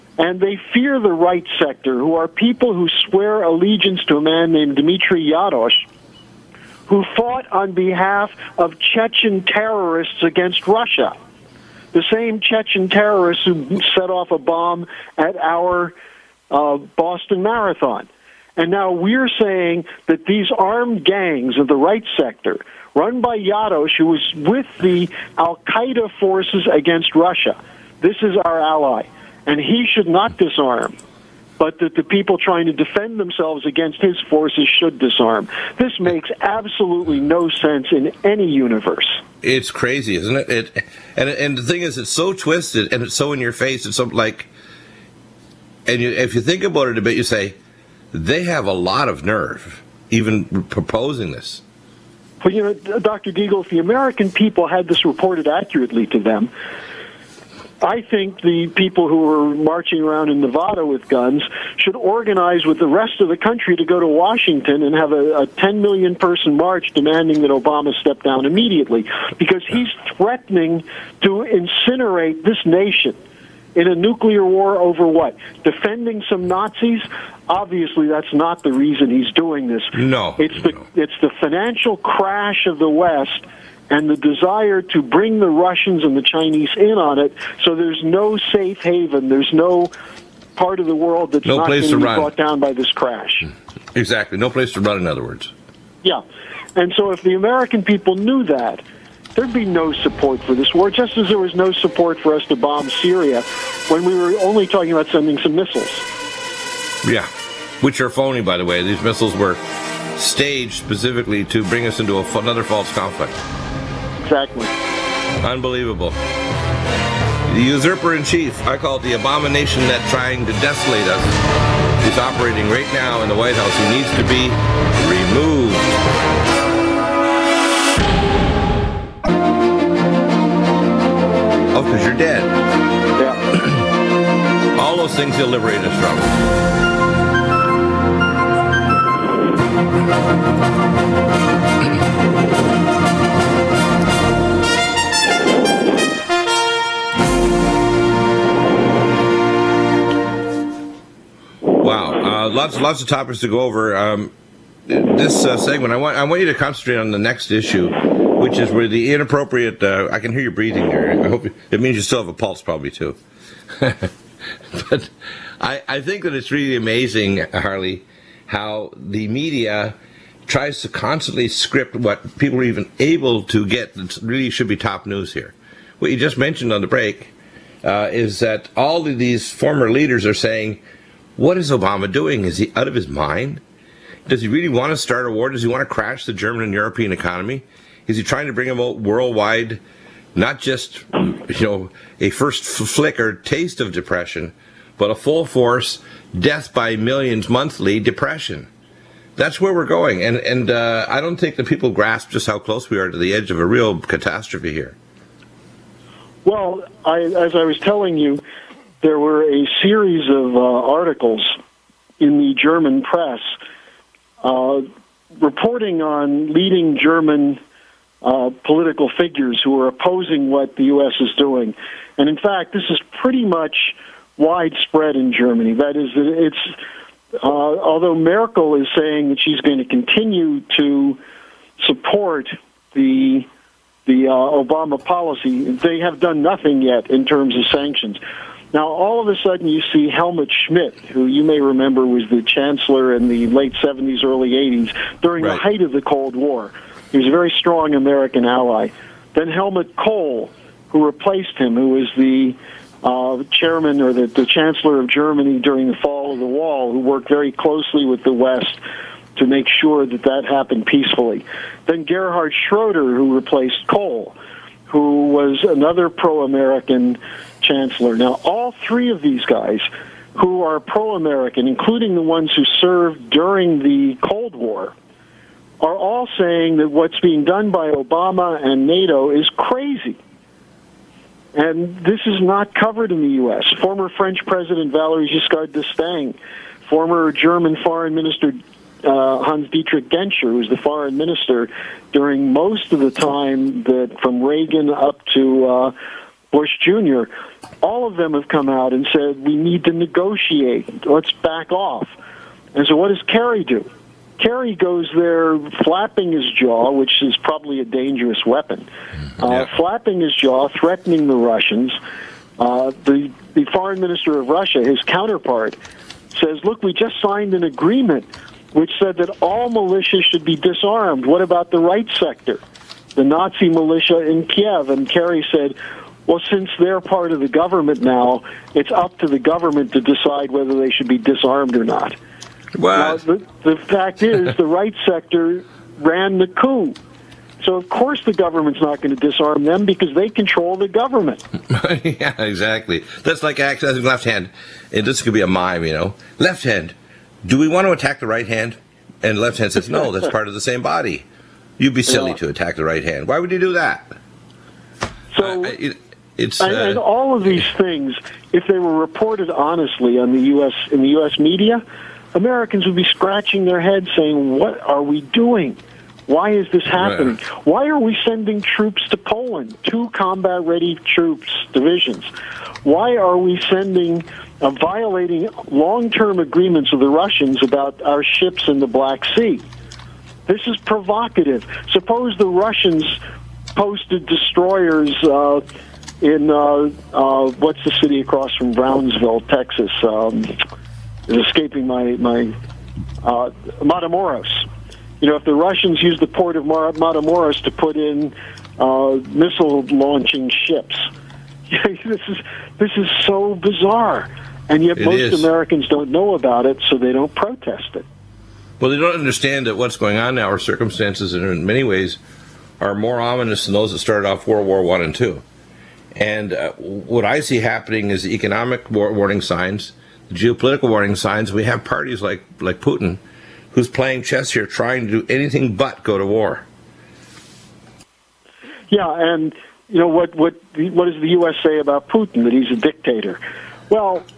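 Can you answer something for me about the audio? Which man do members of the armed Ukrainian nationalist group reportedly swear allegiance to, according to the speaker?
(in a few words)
Dmitry Yarosh.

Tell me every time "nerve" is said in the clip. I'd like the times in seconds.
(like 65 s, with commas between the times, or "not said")
49 s.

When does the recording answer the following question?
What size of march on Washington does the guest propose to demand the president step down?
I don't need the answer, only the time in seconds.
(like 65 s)
65 s.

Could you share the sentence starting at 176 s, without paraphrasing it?
What you just mentioned on the break uh, is that all of these former leaders are saying what is Obama doing?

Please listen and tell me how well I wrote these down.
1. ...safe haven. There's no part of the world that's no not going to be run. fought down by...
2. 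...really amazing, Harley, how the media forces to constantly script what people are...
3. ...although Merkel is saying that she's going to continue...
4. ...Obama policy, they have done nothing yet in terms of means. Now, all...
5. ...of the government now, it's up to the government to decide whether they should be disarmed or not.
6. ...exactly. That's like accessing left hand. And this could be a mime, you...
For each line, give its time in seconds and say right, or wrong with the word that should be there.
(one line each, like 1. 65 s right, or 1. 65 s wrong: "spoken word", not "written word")
1. 88 s wrong: "brought", not "fought"
2. 166 s wrong: "tries", not "forces"
3. 227 s right
4. 234 s wrong: "sanctions", not "means"
5. 327 s right
6. 342 s right.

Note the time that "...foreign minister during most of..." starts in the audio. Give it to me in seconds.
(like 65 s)
290 s.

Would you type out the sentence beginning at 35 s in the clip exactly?
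This makes absolutely no sense in any universe.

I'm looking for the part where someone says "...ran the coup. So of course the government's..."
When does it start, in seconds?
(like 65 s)
335 s.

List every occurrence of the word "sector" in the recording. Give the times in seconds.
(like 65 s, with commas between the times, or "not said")
1 s, 22 s, 322 s, 335 s.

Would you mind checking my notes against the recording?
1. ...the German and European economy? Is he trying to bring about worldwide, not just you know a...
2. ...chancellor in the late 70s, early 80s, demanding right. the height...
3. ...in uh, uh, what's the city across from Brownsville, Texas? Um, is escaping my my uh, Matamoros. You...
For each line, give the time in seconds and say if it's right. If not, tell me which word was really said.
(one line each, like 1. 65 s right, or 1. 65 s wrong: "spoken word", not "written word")
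1. 186 s right
2. 242 s wrong: "during", not "demanding"
3. 386 s right.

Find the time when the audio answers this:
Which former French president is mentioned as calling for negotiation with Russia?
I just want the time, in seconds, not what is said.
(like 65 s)
284 s.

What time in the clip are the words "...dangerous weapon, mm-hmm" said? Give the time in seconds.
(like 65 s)
307 s.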